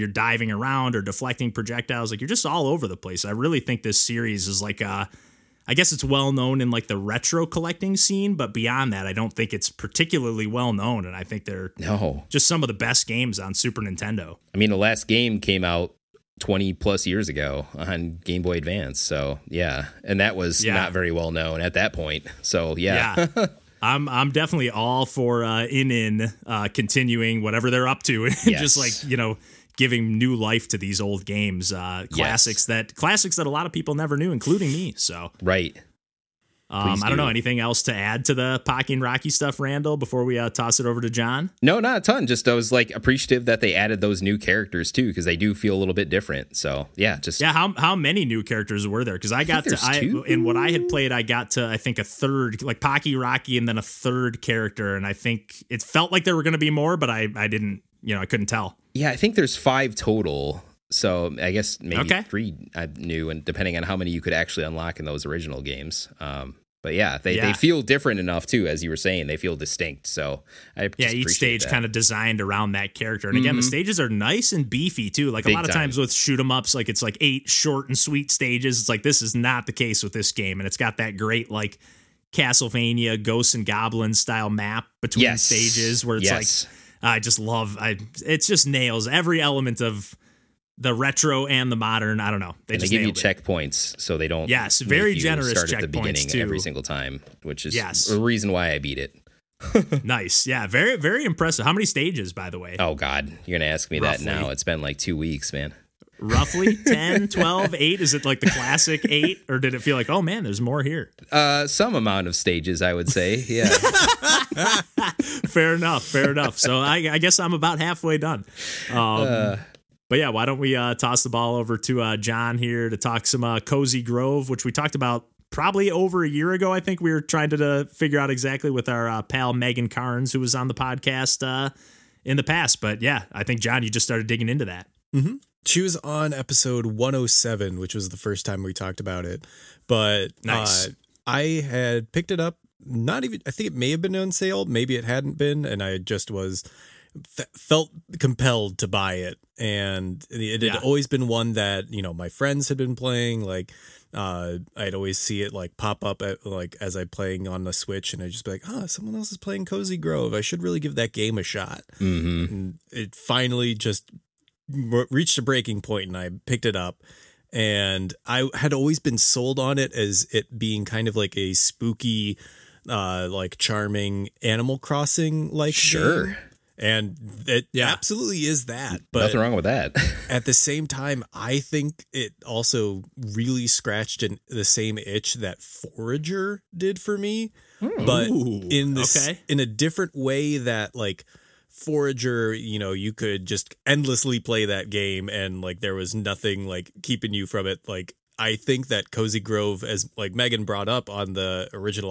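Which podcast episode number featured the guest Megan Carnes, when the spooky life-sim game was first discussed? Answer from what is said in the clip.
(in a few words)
107.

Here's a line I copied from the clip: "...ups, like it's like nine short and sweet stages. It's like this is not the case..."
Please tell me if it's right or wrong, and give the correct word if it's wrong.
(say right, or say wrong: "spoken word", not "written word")
wrong: "eight", not "nine".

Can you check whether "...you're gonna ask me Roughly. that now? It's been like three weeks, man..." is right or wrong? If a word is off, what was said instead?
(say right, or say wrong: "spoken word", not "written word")
wrong: "two", not "three".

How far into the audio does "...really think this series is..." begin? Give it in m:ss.
0:03.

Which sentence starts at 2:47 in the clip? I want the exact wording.
And I had always been sold on it as it being kind of like a spooky, uh, like charming Animal Crossing like.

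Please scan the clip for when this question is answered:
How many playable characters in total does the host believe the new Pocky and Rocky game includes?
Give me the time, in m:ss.
0:59.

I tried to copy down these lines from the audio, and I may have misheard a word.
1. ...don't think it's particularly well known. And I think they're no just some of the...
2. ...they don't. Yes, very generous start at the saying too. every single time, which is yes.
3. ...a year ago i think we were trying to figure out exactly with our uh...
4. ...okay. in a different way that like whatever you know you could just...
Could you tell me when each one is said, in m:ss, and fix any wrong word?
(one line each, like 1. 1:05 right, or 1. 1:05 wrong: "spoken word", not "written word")
1. 0:09 right
2. 1:34 wrong: "beginning", not "saying"
3. 2:06 right
4. 3:09 wrong: "forager", not "whatever".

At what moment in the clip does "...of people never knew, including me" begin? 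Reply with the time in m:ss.
0:33.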